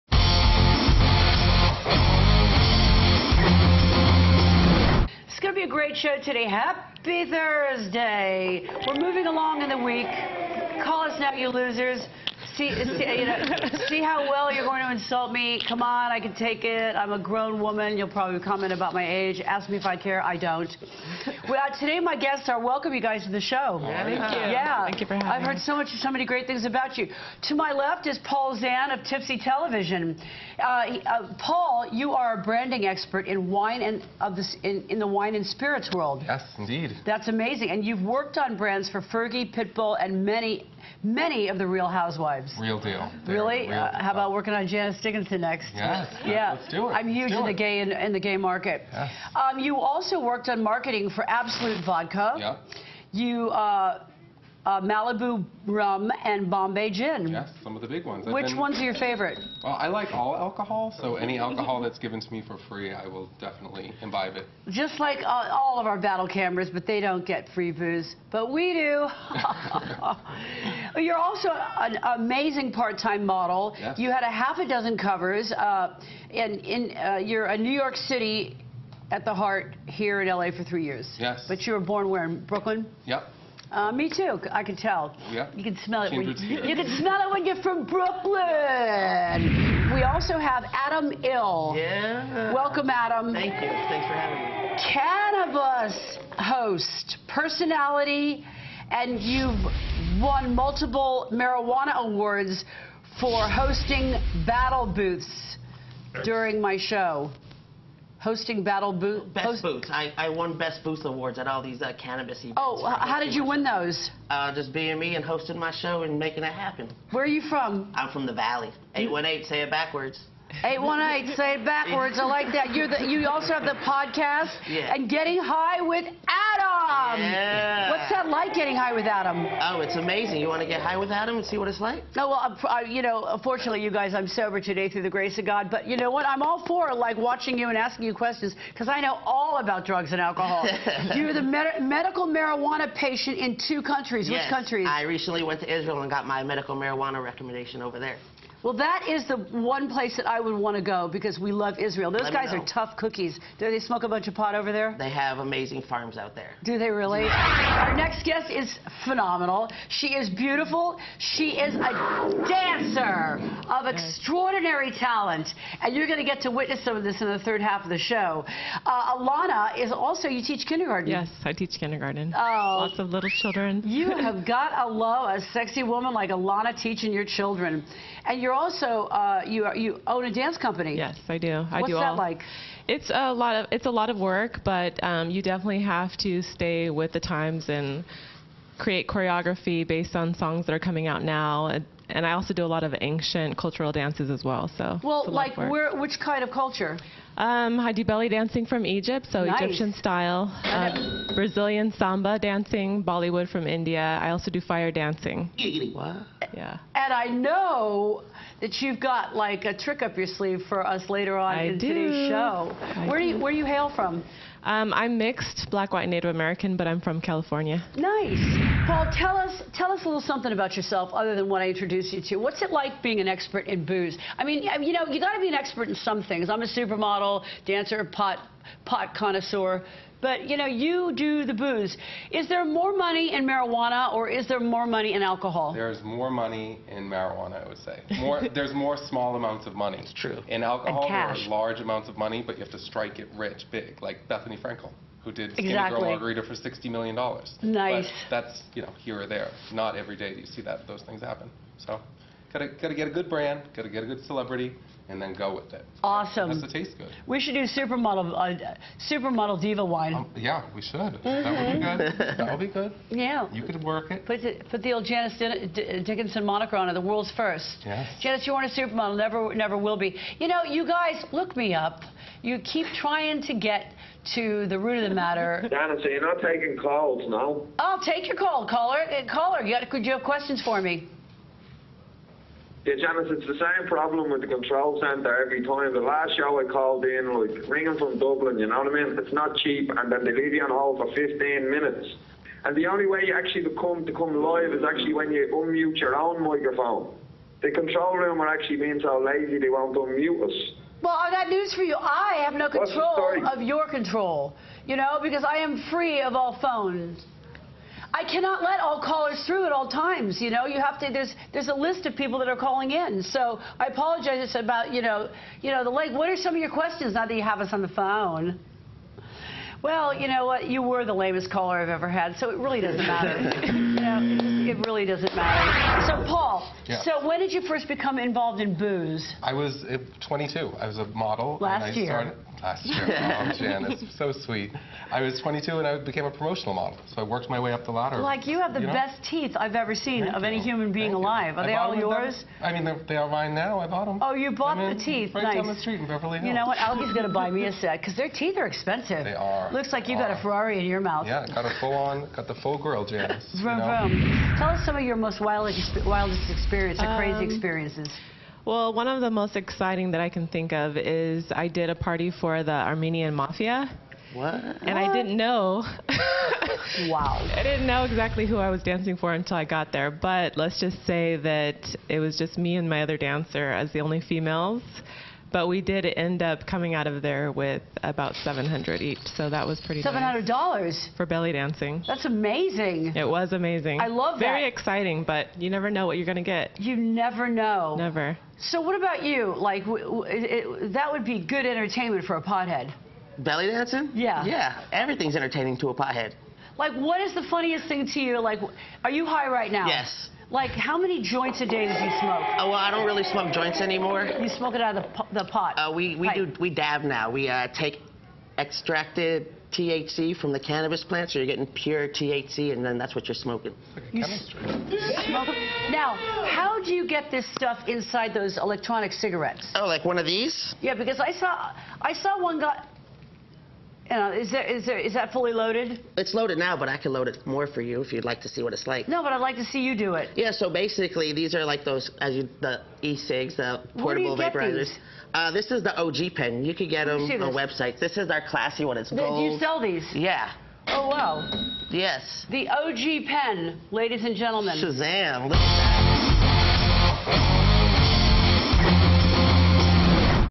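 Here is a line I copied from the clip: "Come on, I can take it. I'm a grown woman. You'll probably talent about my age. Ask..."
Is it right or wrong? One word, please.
wrong.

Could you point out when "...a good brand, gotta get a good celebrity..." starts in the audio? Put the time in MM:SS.
04:13.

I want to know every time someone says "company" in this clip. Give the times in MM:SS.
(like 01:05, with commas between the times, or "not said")
03:00.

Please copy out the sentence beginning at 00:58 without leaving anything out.
Which been, ones are your favorite?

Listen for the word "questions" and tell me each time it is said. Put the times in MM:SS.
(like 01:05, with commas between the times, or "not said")
02:18, 04:40, 05:16.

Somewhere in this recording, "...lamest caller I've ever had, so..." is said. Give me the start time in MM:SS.
05:21.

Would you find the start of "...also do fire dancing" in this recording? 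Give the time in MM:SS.
03:24.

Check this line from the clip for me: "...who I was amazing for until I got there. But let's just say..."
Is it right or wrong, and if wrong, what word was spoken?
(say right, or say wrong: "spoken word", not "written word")
wrong: "dancing", not "amazing".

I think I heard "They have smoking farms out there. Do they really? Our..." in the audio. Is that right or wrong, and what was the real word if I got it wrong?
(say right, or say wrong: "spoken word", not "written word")
wrong: "amazing", not "smoking".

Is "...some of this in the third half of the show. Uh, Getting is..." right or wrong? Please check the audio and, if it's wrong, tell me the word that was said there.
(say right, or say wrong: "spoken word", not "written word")
wrong: "Alana", not "Getting".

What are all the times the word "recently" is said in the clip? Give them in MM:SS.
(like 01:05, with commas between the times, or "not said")
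02:25.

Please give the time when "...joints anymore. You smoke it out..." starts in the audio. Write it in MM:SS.
06:43.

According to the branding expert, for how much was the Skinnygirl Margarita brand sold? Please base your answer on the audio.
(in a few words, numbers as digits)
$60 million.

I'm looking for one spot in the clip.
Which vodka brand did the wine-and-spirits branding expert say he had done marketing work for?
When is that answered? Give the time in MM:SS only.
00:51.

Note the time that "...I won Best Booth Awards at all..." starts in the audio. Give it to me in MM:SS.
01:50.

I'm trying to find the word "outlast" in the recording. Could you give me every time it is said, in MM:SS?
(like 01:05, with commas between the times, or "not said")
not said.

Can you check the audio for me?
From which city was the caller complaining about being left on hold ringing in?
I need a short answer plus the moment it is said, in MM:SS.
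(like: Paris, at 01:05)
Dublin, at 04:48.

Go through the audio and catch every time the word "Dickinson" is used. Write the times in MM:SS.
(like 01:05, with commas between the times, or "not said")
00:45, 04:26.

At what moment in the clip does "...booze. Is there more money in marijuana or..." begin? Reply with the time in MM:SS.
03:51.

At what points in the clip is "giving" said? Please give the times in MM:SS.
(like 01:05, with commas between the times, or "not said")
not said.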